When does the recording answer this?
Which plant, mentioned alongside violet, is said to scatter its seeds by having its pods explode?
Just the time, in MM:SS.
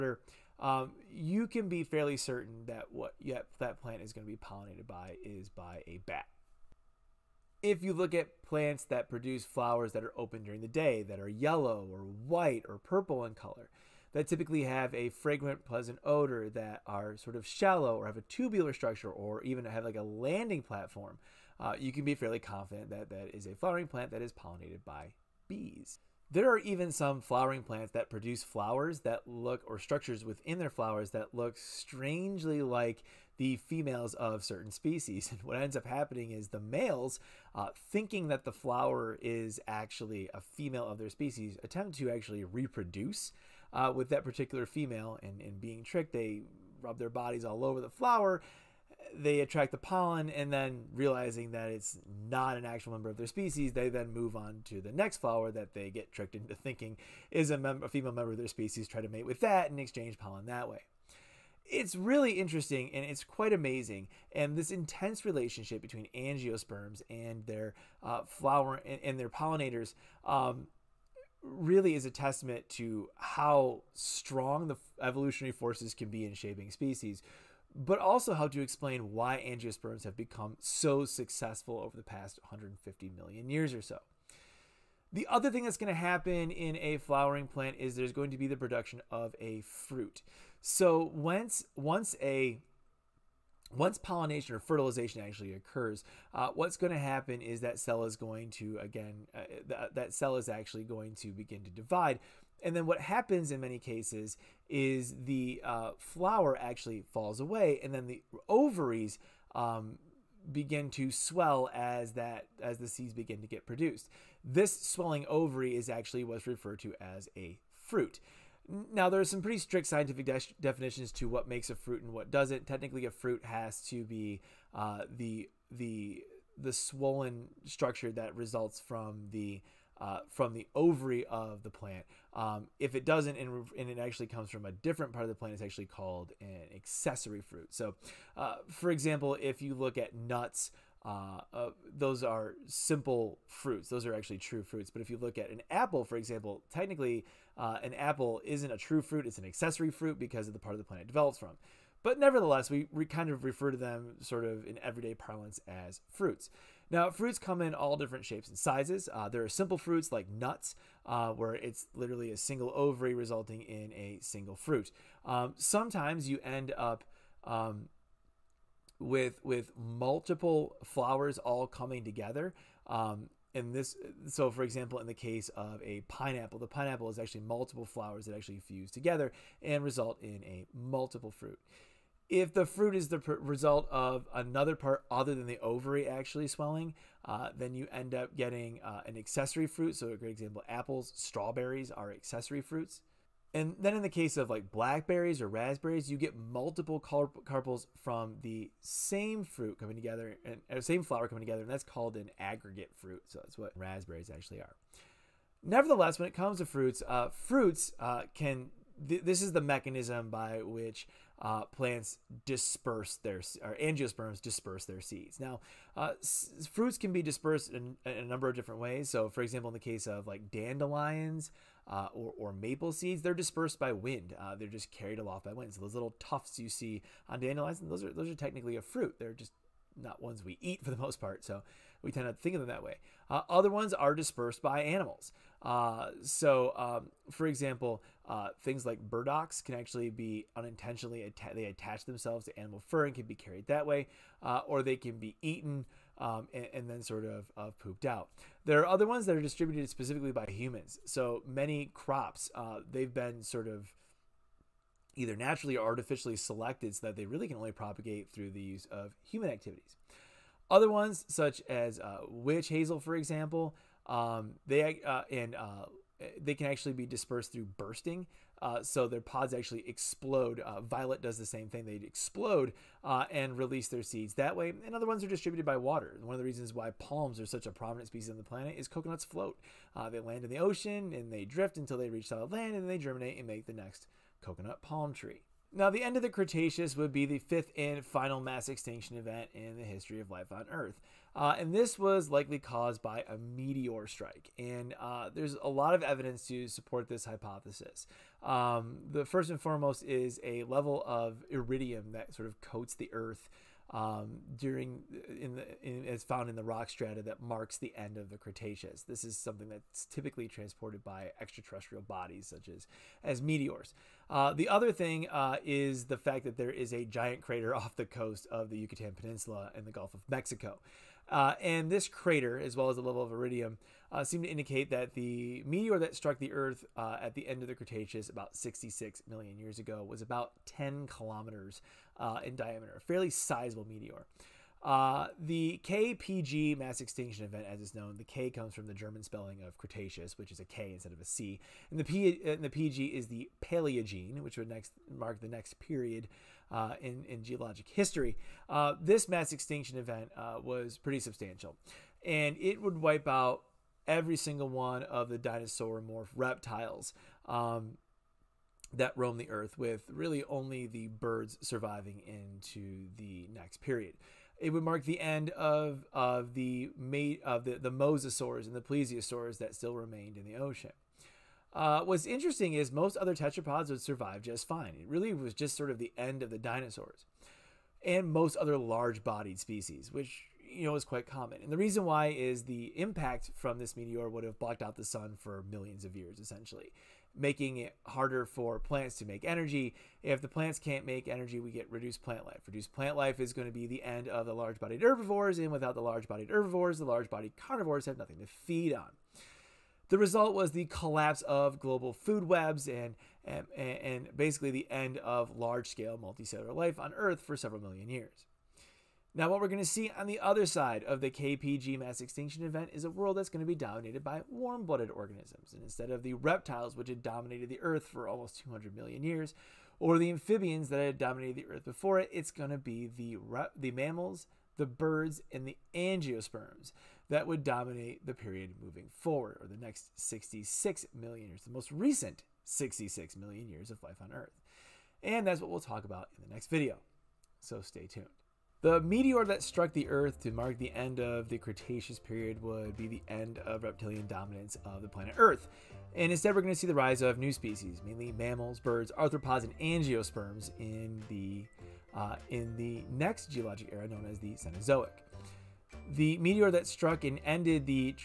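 04:22.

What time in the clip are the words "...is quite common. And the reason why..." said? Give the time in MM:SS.
06:20.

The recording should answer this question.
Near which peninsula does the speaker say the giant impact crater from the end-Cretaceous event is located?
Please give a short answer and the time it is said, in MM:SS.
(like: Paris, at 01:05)
Yucatan Peninsula, at 05:18.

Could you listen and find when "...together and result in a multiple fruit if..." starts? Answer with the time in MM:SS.
02:58.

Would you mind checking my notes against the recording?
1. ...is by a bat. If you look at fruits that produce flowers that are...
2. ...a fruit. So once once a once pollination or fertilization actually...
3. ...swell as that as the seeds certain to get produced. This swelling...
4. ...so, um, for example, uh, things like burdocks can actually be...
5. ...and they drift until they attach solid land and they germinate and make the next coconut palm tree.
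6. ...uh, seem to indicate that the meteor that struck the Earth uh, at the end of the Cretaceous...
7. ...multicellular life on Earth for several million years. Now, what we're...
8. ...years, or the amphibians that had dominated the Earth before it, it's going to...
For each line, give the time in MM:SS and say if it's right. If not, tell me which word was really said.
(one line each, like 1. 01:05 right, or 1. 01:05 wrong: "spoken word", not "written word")
1. 00:05 wrong: "plants", not "fruits"
2. 01:29 right
3. 01:51 wrong: "begin", not "certain"
4. 03:56 right
5. 04:41 wrong: "reach", not "attach"
6. 05:24 right
7. 06:46 right
8. 06:59 right.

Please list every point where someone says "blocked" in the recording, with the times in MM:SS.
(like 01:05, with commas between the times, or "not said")
06:24.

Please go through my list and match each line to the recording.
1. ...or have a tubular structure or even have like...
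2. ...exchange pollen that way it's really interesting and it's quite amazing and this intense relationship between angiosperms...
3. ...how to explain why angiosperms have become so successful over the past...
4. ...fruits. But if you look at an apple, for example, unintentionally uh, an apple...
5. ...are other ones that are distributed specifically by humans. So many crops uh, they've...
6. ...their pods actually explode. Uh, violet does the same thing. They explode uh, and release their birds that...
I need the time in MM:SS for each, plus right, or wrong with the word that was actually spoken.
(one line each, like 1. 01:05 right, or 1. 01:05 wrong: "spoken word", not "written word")
1. 00:17 right
2. 00:59 right
3. 01:18 right
4. 02:24 wrong: "technically", not "unintentionally"
5. 04:08 right
6. 04:29 wrong: "seeds", not "birds".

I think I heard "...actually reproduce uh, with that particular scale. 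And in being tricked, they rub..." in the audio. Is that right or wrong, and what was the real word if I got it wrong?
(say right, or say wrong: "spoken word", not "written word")
wrong: "female", not "scale".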